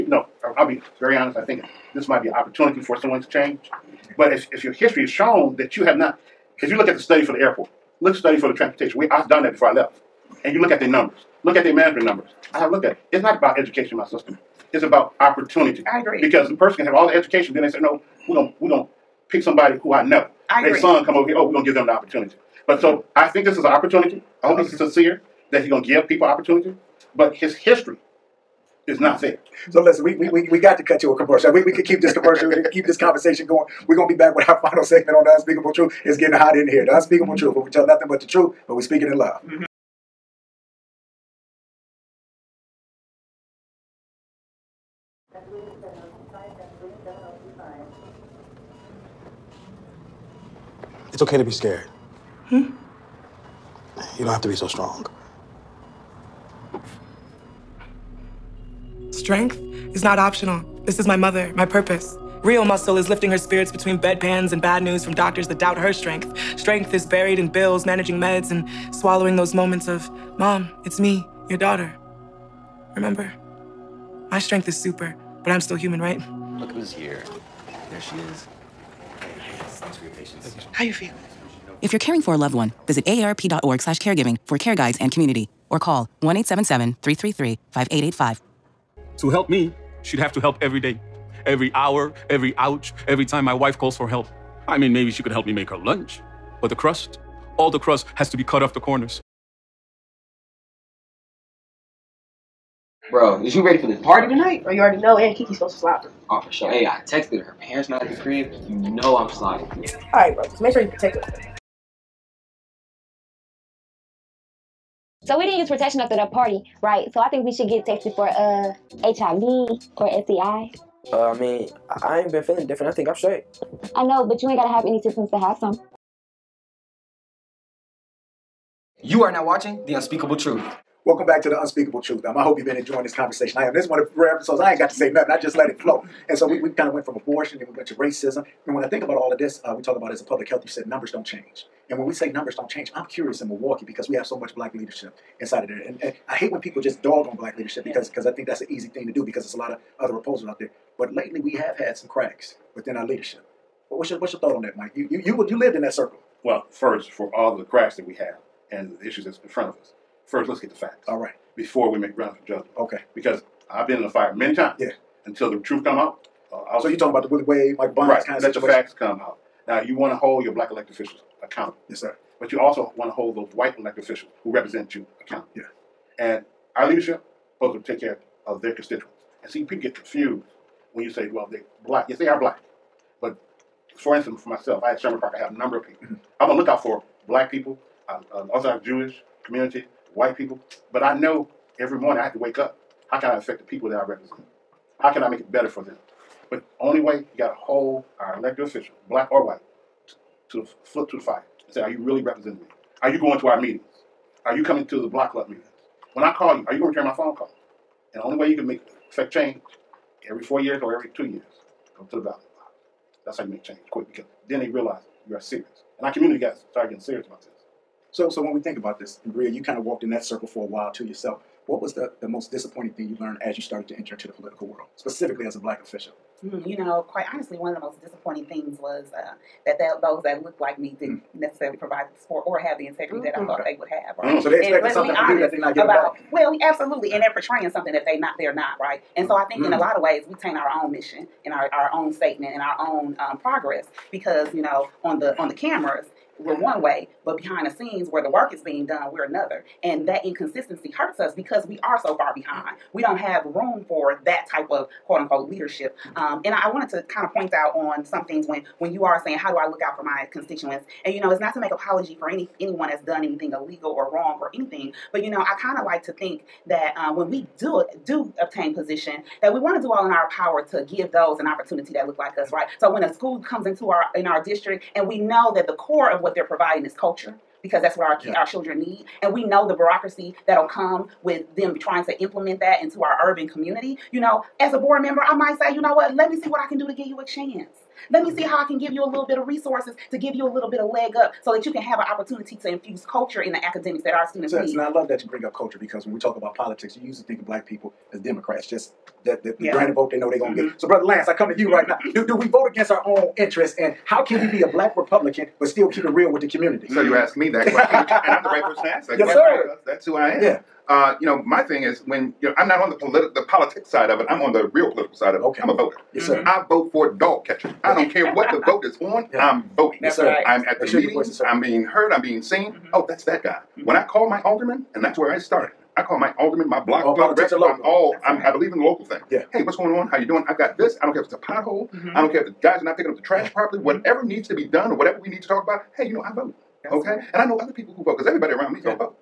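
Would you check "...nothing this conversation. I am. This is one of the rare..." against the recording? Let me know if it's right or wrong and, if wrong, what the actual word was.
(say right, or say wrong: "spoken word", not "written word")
wrong: "enjoying", not "nothing".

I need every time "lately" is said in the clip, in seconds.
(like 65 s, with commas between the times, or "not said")
151 s.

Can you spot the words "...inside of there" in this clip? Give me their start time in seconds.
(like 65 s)
145 s.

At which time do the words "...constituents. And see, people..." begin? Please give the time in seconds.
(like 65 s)
178 s.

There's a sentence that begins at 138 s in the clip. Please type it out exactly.
And when I think about all of this, uh, we talk about as a public health, you said numbers don't change.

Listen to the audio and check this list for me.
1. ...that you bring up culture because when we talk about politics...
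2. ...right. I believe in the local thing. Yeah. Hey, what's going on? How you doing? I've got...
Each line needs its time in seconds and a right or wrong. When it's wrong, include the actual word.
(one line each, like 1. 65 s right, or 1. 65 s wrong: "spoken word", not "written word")
1. 295 s right
2. 328 s right.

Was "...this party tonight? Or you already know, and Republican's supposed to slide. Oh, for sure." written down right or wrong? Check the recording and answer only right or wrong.
wrong.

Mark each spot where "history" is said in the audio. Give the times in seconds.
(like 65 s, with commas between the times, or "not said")
4 s, 27 s.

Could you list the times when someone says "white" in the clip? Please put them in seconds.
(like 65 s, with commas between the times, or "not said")
173 s, 190 s, 199 s.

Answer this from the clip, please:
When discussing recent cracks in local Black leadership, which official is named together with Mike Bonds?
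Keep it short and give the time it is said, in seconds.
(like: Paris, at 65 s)
Willie Wade, at 167 s.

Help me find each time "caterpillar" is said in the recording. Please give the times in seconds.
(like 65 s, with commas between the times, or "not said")
not said.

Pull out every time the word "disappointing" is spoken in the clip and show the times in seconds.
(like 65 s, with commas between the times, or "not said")
222 s, 228 s.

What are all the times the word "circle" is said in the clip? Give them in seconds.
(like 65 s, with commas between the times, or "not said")
155 s, 220 s.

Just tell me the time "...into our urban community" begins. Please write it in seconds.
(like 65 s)
282 s.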